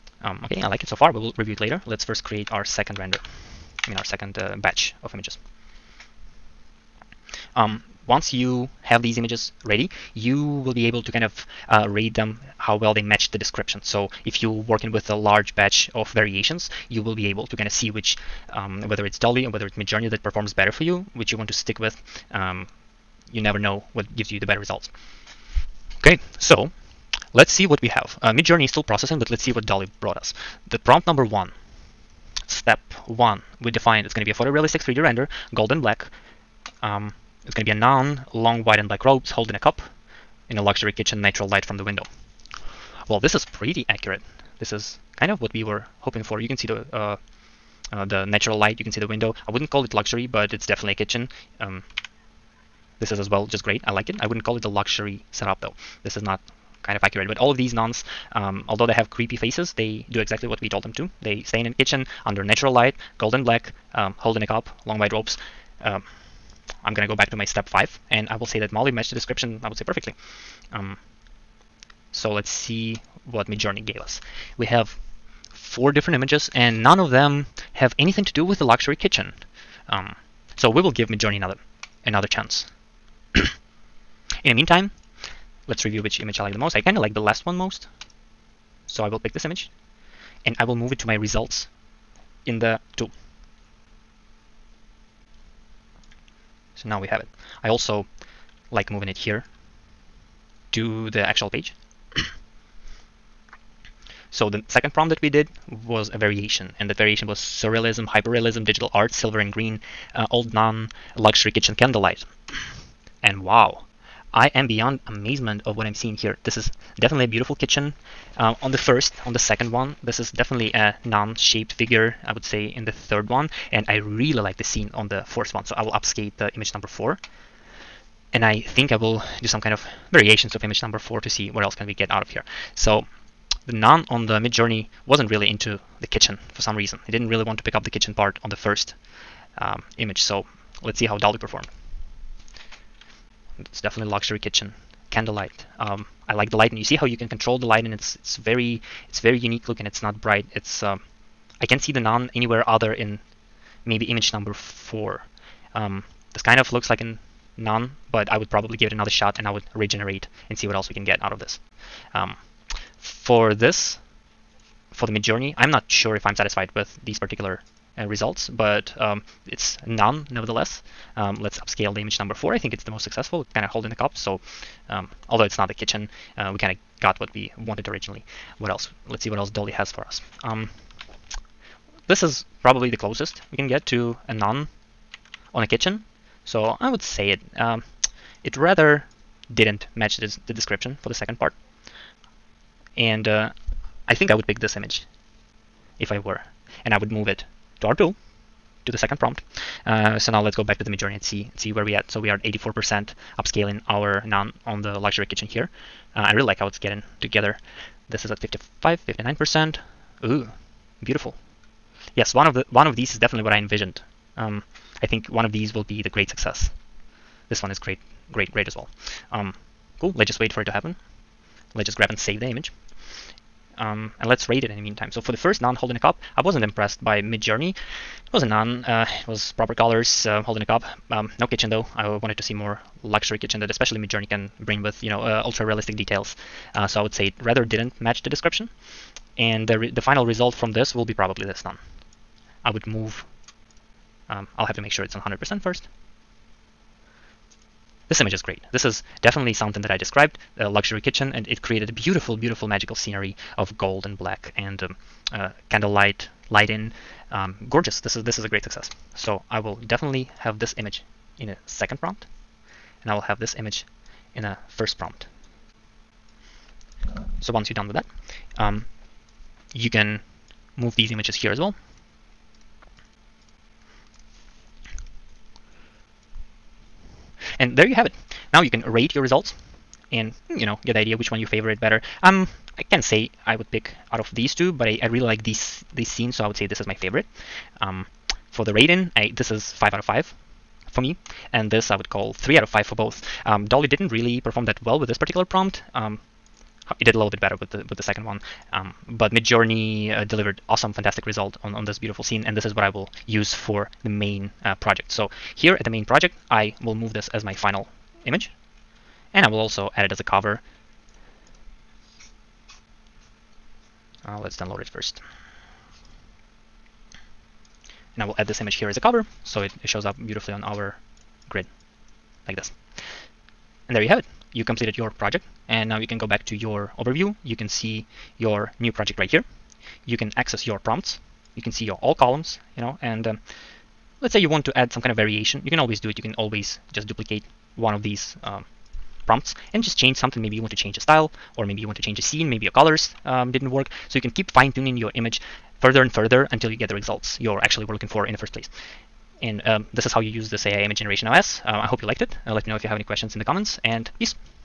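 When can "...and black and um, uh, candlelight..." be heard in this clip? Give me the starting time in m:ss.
4:14.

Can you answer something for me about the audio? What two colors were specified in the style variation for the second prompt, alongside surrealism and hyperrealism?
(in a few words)
Silver and green.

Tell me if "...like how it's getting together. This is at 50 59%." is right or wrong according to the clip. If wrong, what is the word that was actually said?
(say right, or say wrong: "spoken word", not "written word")
right.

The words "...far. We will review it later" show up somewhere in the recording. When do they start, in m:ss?
0:00.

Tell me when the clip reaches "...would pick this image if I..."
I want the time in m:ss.
3:14.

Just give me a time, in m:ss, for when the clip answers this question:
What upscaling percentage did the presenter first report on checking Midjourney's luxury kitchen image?
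3:22.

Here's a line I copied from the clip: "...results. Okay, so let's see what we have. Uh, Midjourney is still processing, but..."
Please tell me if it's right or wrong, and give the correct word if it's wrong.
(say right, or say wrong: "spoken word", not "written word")
right.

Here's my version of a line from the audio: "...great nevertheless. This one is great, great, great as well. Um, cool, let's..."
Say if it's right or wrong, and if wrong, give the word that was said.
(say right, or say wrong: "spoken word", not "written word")
wrong: "success", not "nevertheless".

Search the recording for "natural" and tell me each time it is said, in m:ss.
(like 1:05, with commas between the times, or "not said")
0:41, 0:48, 1:02.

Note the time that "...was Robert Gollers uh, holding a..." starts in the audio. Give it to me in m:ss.
3:49.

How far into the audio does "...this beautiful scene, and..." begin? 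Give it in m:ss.
5:01.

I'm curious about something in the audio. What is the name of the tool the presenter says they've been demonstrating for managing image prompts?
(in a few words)
AI Image Generation OS.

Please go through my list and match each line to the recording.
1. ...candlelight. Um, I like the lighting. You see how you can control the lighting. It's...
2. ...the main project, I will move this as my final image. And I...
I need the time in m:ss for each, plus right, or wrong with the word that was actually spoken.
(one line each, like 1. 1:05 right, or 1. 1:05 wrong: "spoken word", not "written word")
1. 2:25 right
2. 5:05 right.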